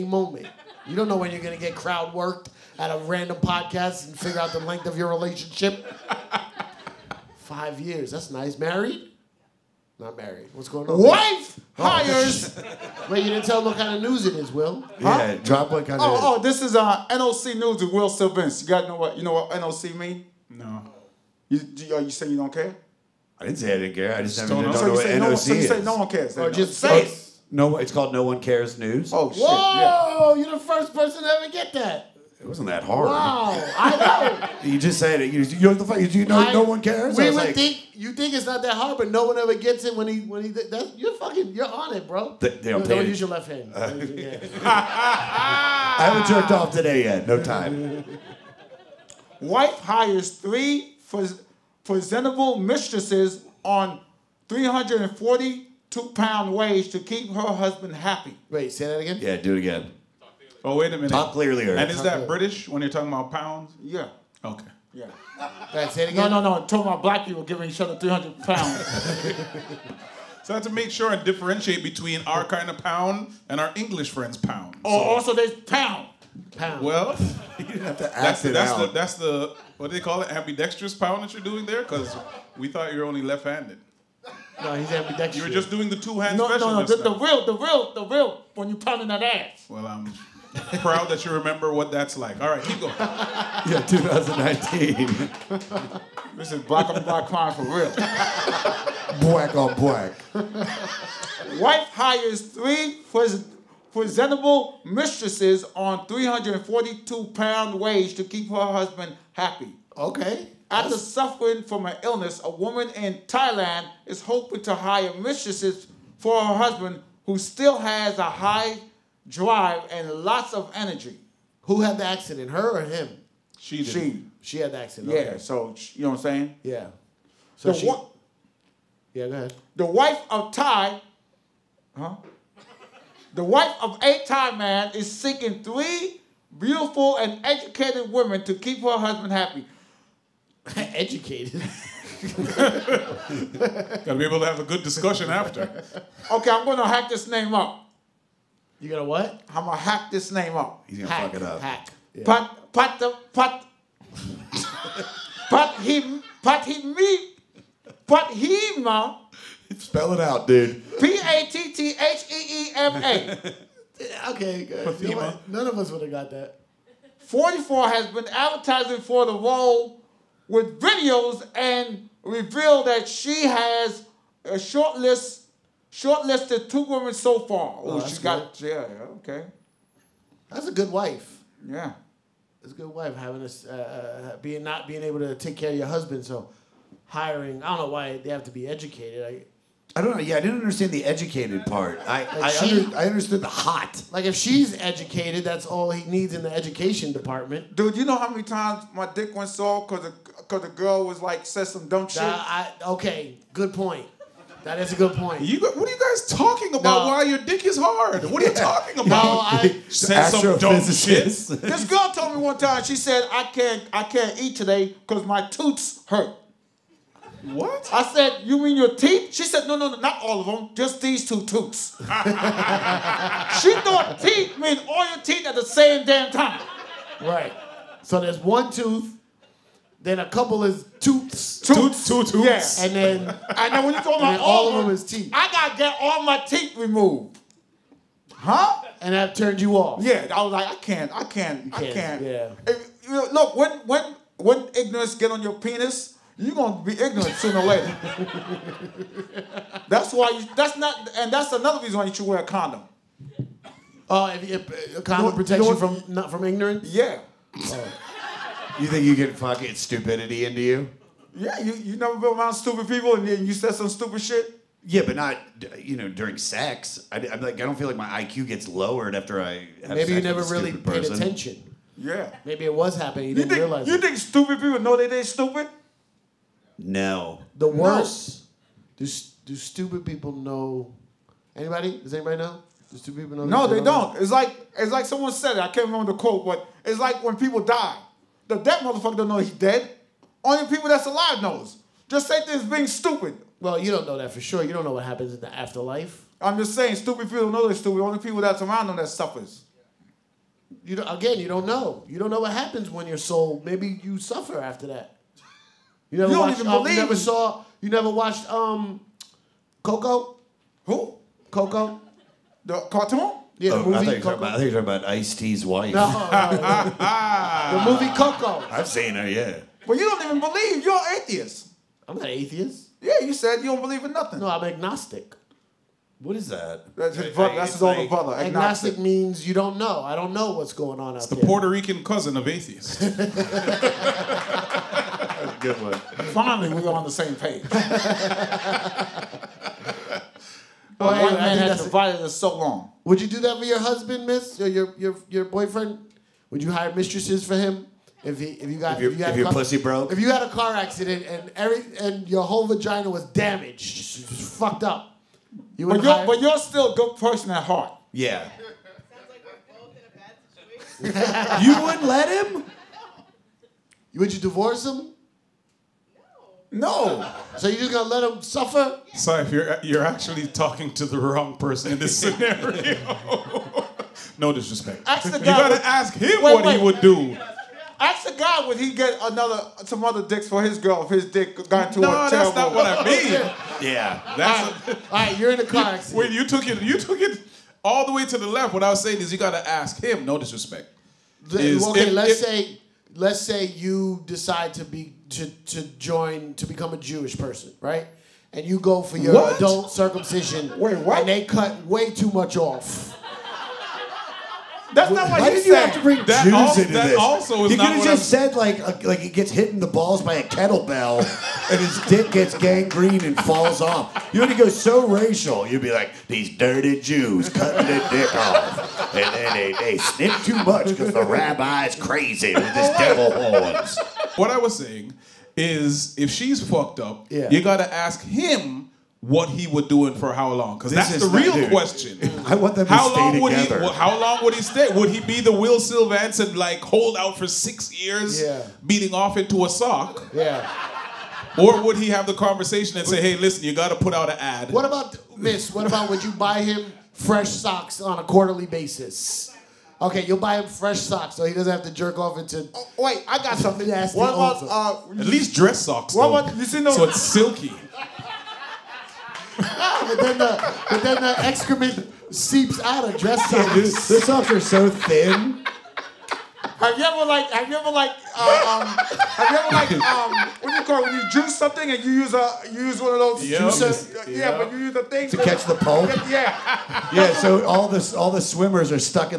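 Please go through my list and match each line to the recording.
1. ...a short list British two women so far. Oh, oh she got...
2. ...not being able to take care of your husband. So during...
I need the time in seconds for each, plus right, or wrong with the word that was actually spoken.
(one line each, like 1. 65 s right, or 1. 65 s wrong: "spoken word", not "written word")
1. 174 s wrong: "Shortlisted", not "British"
2. 184 s wrong: "hiring", not "during".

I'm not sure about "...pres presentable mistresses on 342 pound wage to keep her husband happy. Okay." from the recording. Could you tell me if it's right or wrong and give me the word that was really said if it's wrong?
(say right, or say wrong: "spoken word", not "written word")
right.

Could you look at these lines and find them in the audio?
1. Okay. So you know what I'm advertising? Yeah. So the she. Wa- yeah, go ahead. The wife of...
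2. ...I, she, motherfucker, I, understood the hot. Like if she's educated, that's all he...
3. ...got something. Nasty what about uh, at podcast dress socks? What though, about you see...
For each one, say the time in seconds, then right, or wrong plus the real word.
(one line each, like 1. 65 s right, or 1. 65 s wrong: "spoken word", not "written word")
1. 125 s wrong: "saying", not "advertising"
2. 192 s wrong: "under", not "motherfucker"
3. 453 s wrong: "least", not "podcast".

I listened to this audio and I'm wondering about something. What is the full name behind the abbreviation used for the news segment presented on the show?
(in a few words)
No One Cares News.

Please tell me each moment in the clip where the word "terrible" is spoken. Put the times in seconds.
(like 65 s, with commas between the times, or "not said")
382 s.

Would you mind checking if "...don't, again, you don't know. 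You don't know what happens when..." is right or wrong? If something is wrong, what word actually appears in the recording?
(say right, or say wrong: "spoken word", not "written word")
right.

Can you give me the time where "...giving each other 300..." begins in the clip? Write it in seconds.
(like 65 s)
67 s.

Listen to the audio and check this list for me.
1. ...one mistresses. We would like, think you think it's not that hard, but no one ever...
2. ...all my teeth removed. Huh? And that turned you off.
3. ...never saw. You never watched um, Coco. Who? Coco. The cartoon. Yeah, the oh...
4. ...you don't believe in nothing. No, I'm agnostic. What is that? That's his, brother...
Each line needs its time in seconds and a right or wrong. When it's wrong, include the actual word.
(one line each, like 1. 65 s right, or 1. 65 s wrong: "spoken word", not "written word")
1. 36 s wrong: "cares", not "mistresses"
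2. 235 s right
3. 307 s right
4. 323 s right.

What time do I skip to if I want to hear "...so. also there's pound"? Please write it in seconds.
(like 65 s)
75 s.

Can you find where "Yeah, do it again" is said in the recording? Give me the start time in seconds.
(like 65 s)
59 s.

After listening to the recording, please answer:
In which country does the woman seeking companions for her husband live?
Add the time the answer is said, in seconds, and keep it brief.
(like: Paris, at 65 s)
Thailand, at 113 s.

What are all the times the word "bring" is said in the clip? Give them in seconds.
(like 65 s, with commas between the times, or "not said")
406 s.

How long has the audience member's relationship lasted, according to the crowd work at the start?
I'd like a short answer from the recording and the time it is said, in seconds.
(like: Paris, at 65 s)
5 years, at 7 s.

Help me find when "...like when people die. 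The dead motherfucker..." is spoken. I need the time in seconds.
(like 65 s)
286 s.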